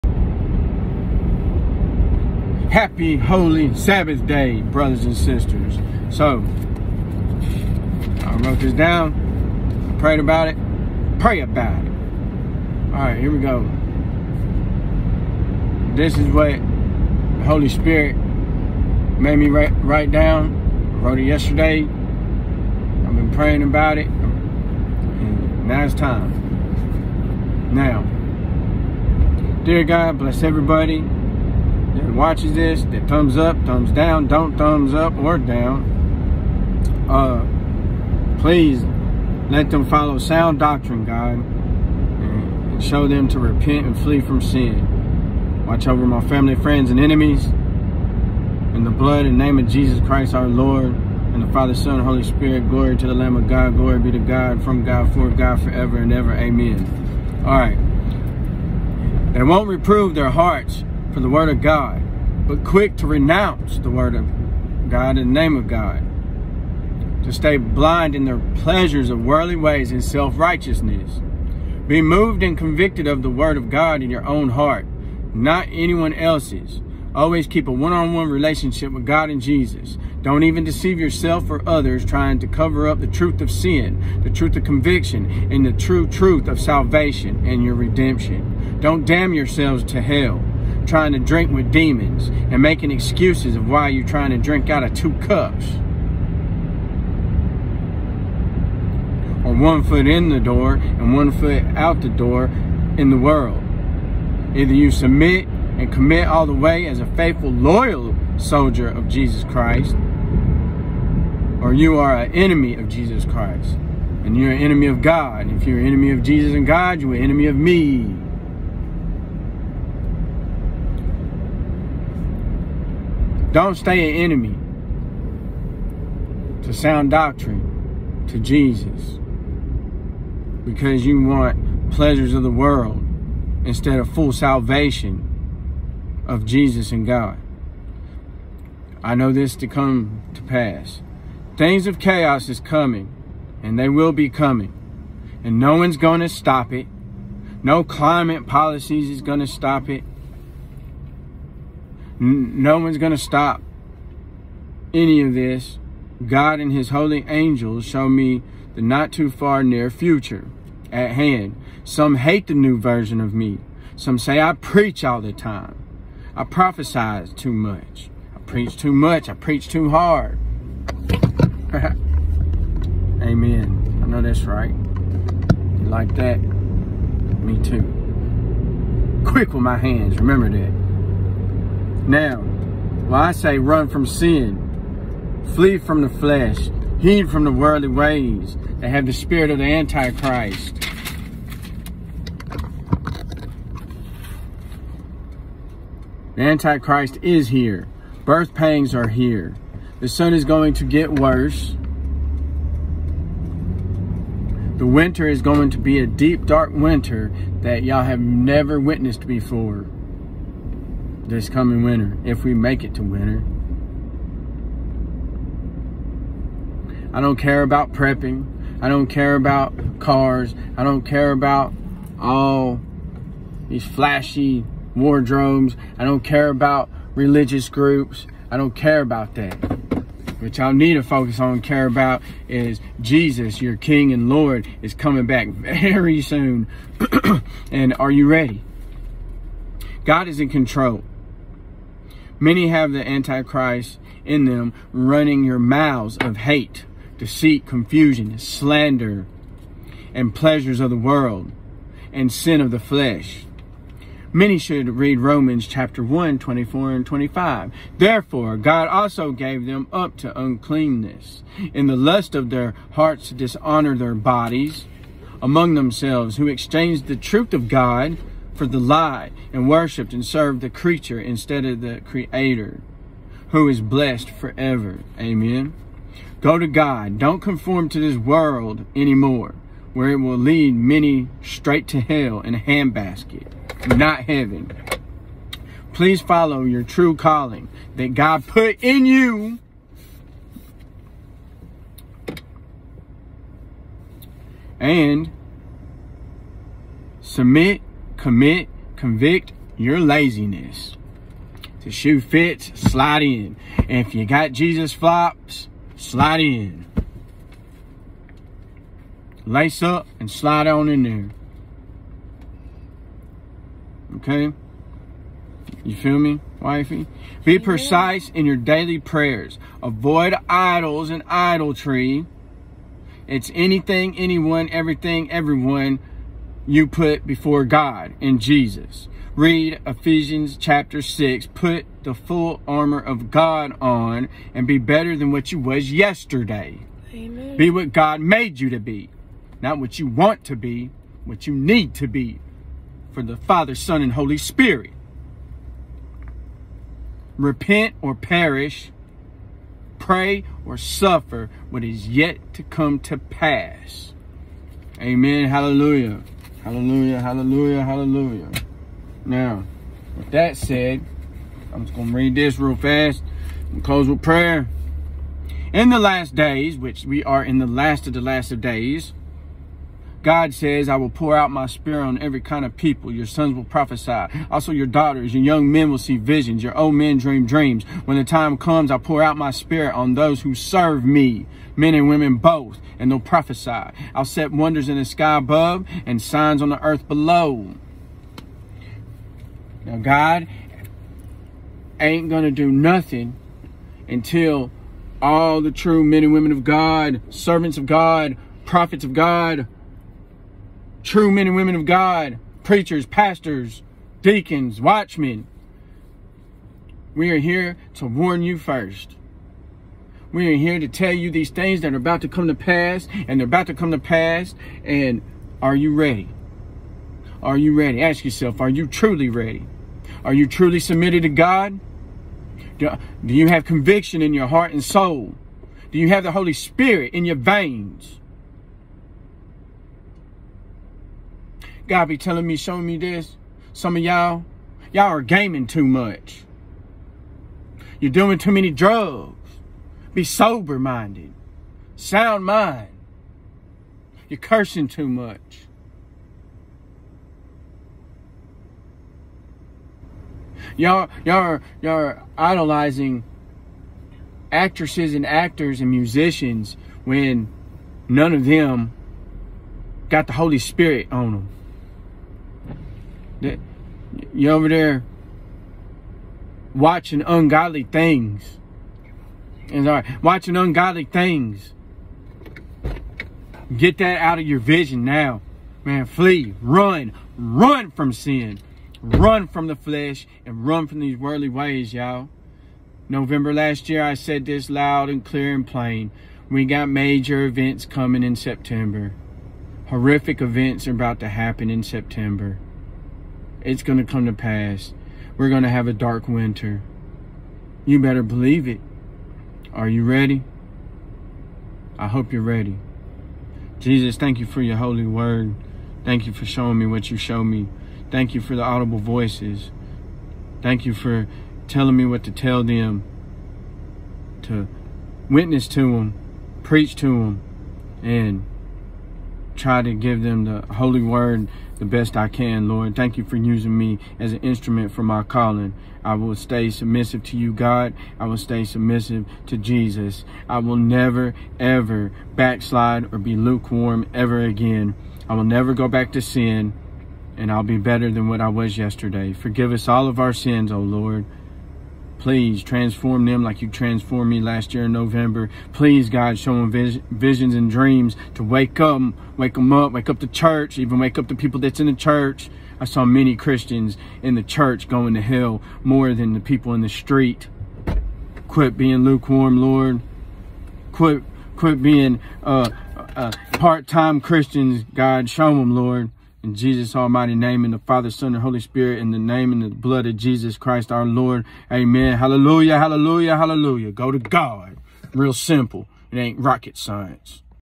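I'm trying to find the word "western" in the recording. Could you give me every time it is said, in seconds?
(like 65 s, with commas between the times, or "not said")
not said.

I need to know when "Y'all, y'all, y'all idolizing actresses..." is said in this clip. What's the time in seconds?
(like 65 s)
450 s.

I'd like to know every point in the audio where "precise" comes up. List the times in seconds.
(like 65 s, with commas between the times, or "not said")
317 s.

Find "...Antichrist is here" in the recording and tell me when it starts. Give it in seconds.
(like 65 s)
196 s.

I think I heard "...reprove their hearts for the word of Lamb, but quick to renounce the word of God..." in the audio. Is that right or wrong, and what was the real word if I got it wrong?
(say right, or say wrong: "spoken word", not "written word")
wrong: "God", not "Lamb".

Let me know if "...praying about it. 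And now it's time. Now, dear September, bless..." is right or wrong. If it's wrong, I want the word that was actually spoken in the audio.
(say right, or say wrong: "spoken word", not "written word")
wrong: "God", not "September".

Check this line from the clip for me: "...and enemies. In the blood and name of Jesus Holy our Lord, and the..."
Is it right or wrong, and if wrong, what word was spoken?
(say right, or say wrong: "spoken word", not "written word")
wrong: "Christ", not "Holy".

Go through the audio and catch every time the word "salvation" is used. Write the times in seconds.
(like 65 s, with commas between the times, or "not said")
86 s, 134 s.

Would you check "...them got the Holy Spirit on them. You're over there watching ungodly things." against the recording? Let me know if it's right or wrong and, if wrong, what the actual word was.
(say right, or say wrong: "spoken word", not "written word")
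right.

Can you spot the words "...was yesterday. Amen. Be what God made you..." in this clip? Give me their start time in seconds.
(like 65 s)
335 s.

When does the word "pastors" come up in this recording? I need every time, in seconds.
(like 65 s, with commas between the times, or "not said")
403 s.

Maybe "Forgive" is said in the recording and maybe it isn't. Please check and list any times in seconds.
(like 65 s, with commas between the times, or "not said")
539 s.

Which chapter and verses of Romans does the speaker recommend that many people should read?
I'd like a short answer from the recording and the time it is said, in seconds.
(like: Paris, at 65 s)
Romans 1:24-25, at 255 s.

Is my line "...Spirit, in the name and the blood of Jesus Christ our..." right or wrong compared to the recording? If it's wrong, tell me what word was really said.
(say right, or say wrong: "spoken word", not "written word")
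right.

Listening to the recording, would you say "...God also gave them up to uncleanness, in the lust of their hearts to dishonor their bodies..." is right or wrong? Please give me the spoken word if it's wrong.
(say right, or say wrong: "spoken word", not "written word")
right.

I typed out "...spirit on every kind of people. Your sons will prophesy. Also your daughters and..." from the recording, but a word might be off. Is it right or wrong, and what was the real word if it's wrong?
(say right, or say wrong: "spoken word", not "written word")
right.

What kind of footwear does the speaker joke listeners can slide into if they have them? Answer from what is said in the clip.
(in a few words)
Jesus flops.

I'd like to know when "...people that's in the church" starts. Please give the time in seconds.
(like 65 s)
551 s.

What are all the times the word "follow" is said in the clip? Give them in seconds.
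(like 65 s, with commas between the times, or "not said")
39 s, 286 s.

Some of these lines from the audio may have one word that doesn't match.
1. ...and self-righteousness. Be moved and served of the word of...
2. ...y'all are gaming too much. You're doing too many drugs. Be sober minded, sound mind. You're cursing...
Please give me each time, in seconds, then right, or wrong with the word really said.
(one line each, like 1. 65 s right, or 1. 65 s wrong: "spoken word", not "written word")
1. 69 s wrong: "convicted", not "served"
2. 434 s right.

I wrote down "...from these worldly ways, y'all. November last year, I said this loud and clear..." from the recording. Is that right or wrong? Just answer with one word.
right.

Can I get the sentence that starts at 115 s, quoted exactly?
And if you're an enemy of Jesus and God, you're an enemy of me.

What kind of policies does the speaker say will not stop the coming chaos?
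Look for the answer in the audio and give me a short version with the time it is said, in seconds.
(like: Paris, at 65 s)
Climate policies, at 147 s.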